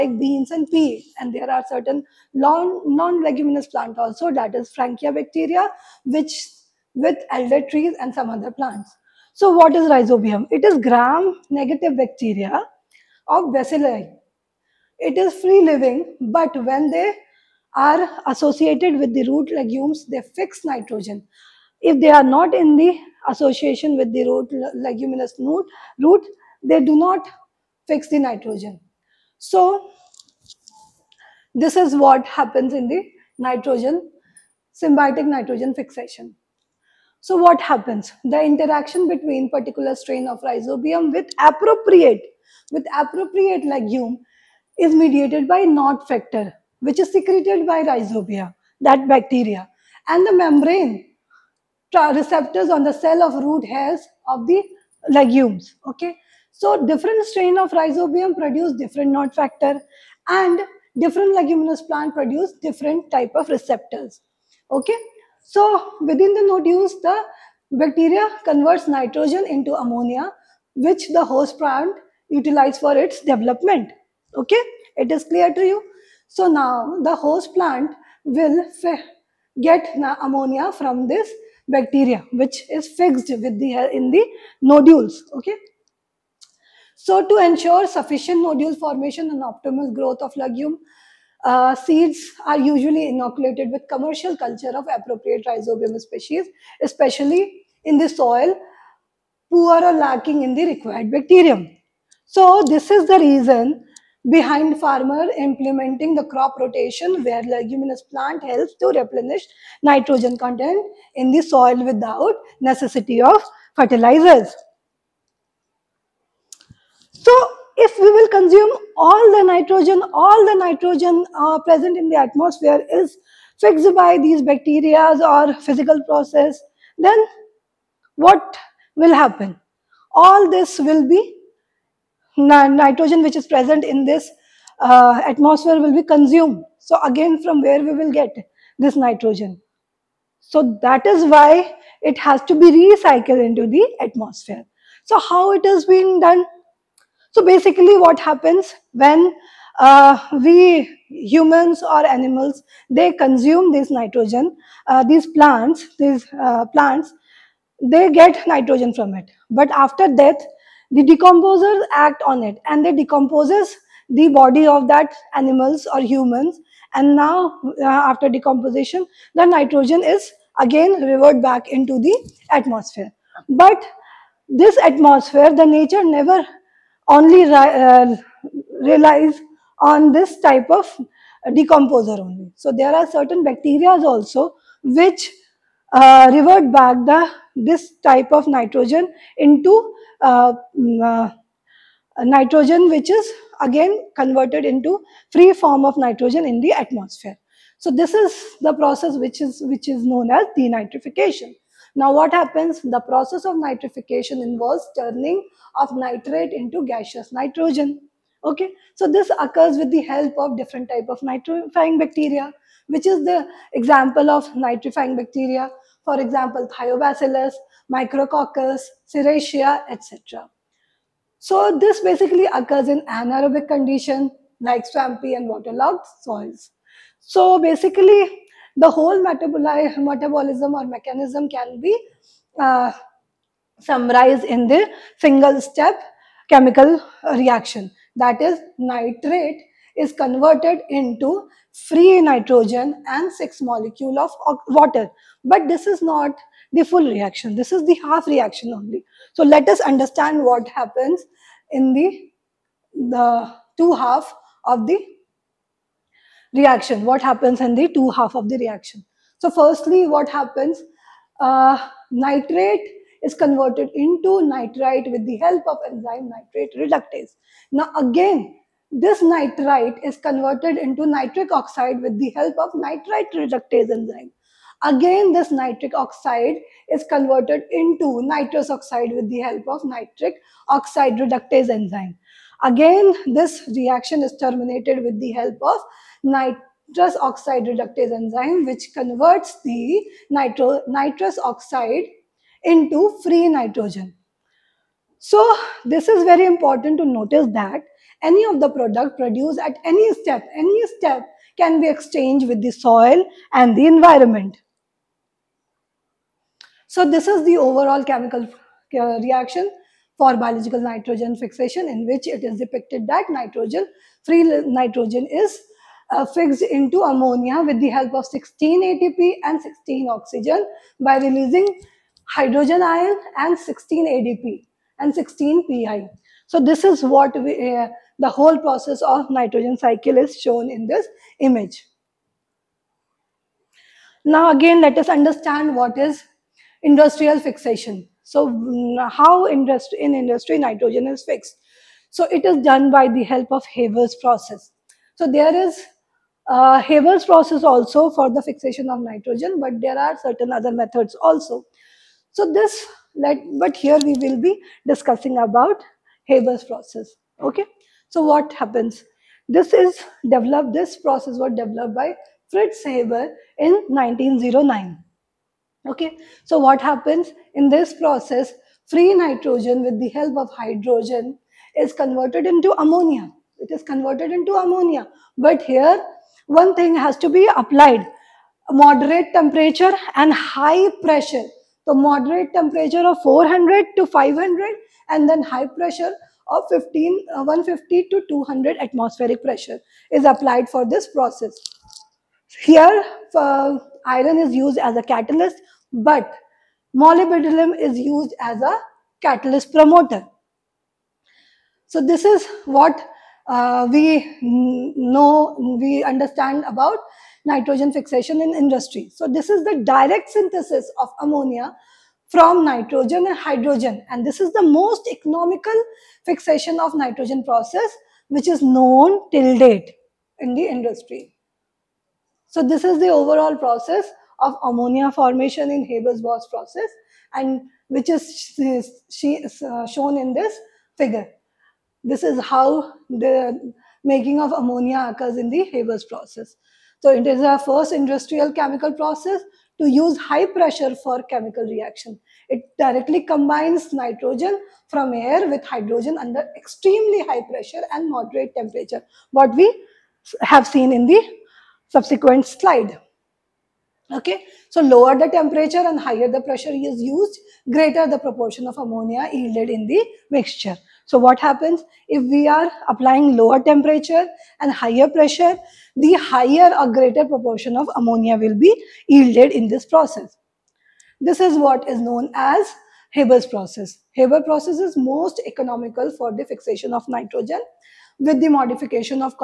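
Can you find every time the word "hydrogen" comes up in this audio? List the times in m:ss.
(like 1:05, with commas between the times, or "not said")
5:22, 6:10, 6:53, 7:25.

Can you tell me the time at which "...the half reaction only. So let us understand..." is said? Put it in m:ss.
4:07.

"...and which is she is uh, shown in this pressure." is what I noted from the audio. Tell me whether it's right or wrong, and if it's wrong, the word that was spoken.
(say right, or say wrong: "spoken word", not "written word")
wrong: "figure", not "pressure".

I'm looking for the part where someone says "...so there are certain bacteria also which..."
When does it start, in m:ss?
3:02.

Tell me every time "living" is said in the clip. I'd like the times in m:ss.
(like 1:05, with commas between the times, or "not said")
0:15.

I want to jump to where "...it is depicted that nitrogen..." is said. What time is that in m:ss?
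5:12.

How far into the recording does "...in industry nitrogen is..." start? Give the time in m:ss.
5:39.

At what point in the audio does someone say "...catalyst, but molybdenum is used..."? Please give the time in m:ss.
6:35.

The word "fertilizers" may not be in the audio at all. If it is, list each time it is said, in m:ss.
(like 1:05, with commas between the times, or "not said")
1:53.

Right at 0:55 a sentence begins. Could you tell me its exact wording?
Okay, so different strain of rhizobium produce different Nod factor, and different leguminous plant produce different type of receptors.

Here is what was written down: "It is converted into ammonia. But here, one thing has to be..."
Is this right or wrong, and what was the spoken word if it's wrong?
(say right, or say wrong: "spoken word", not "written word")
right.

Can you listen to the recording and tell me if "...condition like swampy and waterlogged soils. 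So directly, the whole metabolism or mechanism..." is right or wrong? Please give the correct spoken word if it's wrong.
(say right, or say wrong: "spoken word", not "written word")
wrong: "basically", not "directly".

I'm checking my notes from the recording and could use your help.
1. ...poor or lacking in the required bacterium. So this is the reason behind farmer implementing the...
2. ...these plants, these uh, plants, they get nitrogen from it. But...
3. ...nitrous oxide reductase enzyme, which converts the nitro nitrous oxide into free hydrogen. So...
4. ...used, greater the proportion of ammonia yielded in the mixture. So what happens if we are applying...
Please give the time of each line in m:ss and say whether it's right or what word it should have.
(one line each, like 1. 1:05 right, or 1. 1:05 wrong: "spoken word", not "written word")
1. 1:39 right
2. 2:35 right
3. 4:46 wrong: "nitrogen", not "hydrogen"
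4. 7:37 right.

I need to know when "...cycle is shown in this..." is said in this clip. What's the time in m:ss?
5:29.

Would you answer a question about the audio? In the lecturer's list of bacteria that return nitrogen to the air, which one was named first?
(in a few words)
Thiobacillus.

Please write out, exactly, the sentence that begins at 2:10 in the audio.
All this will be nitrogen which is present in this uh, atmosphere will be consumed.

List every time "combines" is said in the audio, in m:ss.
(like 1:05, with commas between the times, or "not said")
7:23.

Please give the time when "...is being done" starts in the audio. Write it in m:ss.
2:25.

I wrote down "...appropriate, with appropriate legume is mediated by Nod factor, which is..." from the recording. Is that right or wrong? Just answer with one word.
right.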